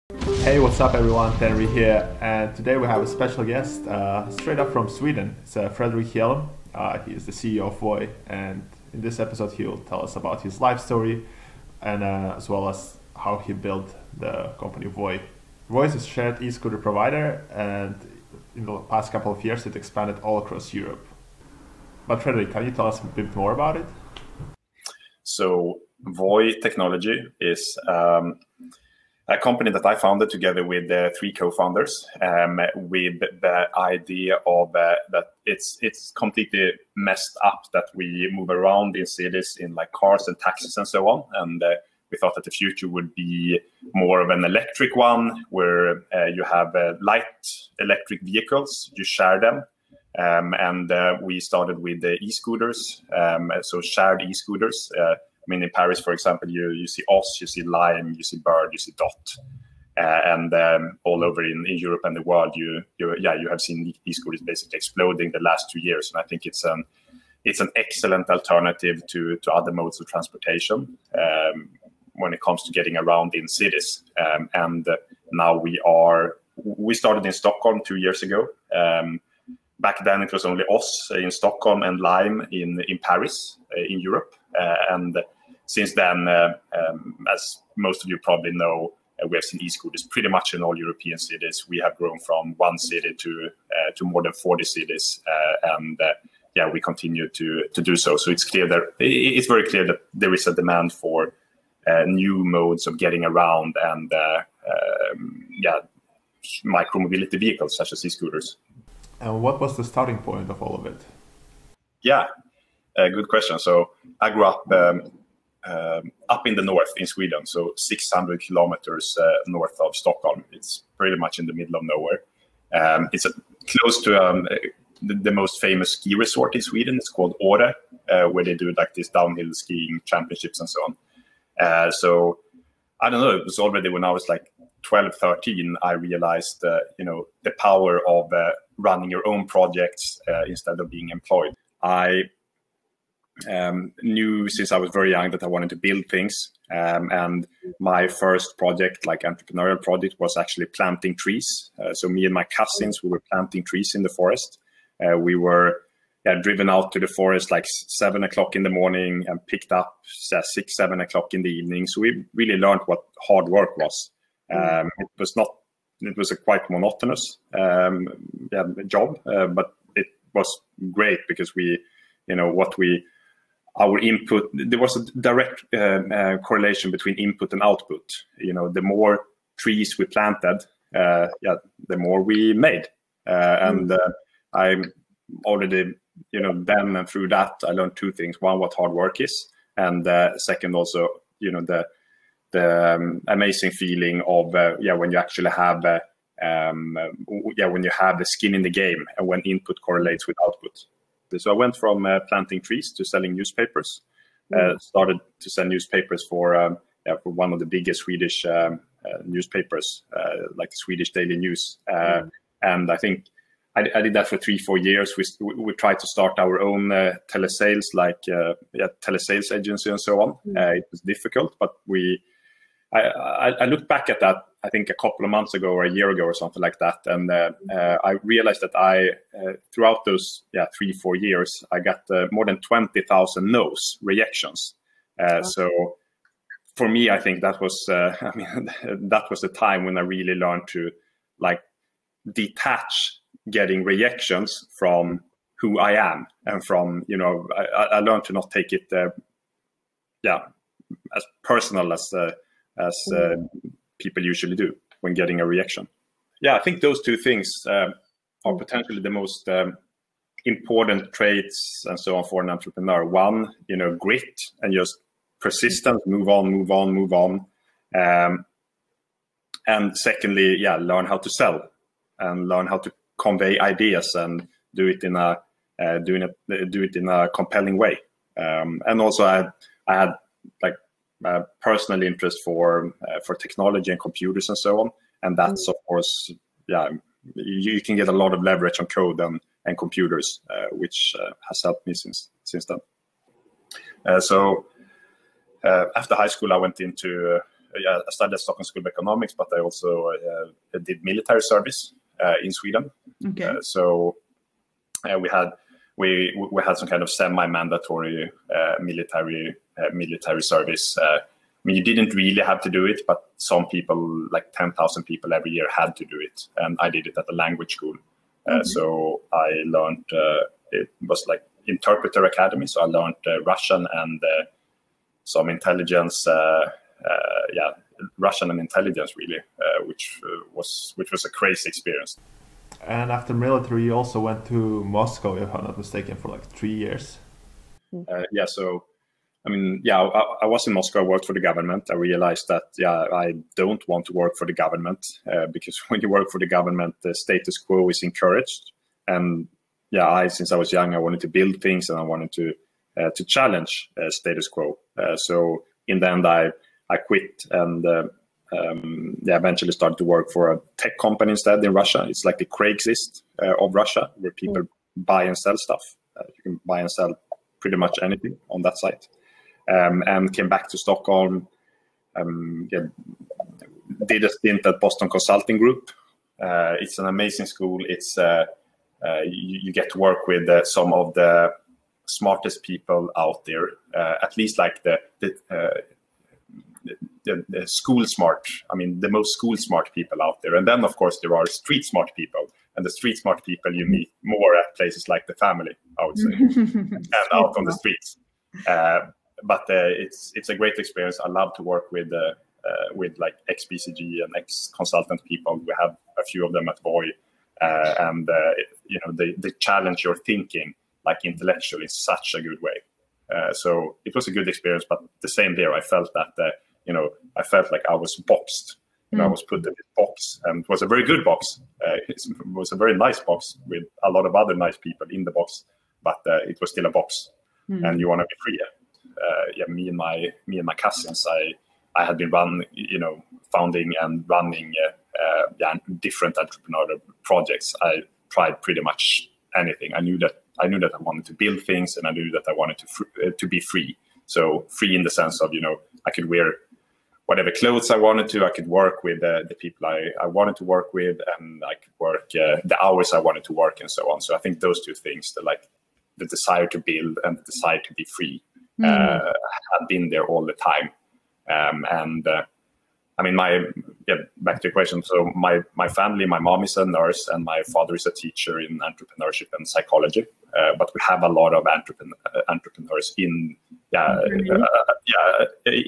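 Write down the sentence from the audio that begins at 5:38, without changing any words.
yeah, so I mean, yeah, I, I, was in Moscow.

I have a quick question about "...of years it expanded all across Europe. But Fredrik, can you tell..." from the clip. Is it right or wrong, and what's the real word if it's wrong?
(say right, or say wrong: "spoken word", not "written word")
right.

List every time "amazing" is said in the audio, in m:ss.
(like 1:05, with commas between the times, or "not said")
3:13, 6:17.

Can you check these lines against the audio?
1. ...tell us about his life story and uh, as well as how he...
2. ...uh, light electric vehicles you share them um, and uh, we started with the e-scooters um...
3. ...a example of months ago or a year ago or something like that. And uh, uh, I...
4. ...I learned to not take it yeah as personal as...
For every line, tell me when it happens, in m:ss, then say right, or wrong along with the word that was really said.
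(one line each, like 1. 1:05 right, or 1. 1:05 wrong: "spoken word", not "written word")
1. 0:09 right
2. 0:46 right
3. 3:44 wrong: "couple", not "example"
4. 4:07 right.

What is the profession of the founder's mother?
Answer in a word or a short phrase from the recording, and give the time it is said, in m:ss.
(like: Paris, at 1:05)
Nurse, at 7:46.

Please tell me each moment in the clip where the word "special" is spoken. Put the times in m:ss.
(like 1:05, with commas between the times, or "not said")
0:03.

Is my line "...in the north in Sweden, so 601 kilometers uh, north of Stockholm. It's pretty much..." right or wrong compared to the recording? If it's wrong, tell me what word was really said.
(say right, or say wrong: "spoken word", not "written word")
wrong: "600", not "601".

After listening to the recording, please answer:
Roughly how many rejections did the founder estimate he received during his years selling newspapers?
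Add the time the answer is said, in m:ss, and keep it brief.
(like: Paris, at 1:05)
20,000, at 3:52.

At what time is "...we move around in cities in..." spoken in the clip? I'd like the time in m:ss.
0:37.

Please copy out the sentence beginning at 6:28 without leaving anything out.
I mean, the most school smart people out there.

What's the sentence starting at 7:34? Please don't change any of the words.
So I think those two things, the like the desire to build and the desire to be free, mm.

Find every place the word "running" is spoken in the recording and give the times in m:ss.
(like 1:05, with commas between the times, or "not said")
2:18, 7:14.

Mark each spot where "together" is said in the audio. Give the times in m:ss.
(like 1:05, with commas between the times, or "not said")
0:30.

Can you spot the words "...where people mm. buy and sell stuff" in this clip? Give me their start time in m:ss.
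6:04.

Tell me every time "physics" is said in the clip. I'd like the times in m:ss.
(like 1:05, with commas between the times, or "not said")
not said.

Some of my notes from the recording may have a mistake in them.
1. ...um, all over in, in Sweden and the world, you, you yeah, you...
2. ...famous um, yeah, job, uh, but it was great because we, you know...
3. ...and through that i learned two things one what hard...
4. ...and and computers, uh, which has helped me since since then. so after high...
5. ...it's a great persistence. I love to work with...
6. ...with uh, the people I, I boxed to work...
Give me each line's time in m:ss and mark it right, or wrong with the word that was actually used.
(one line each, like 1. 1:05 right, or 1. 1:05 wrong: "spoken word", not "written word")
1. 1:00 wrong: "Europe", not "Sweden"
2. 2:46 wrong: "monotonous", not "famous"
3. 3:06 right
4. 4:49 right
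5. 6:40 wrong: "experience", not "persistence"
6. 7:29 wrong: "wanted", not "boxed".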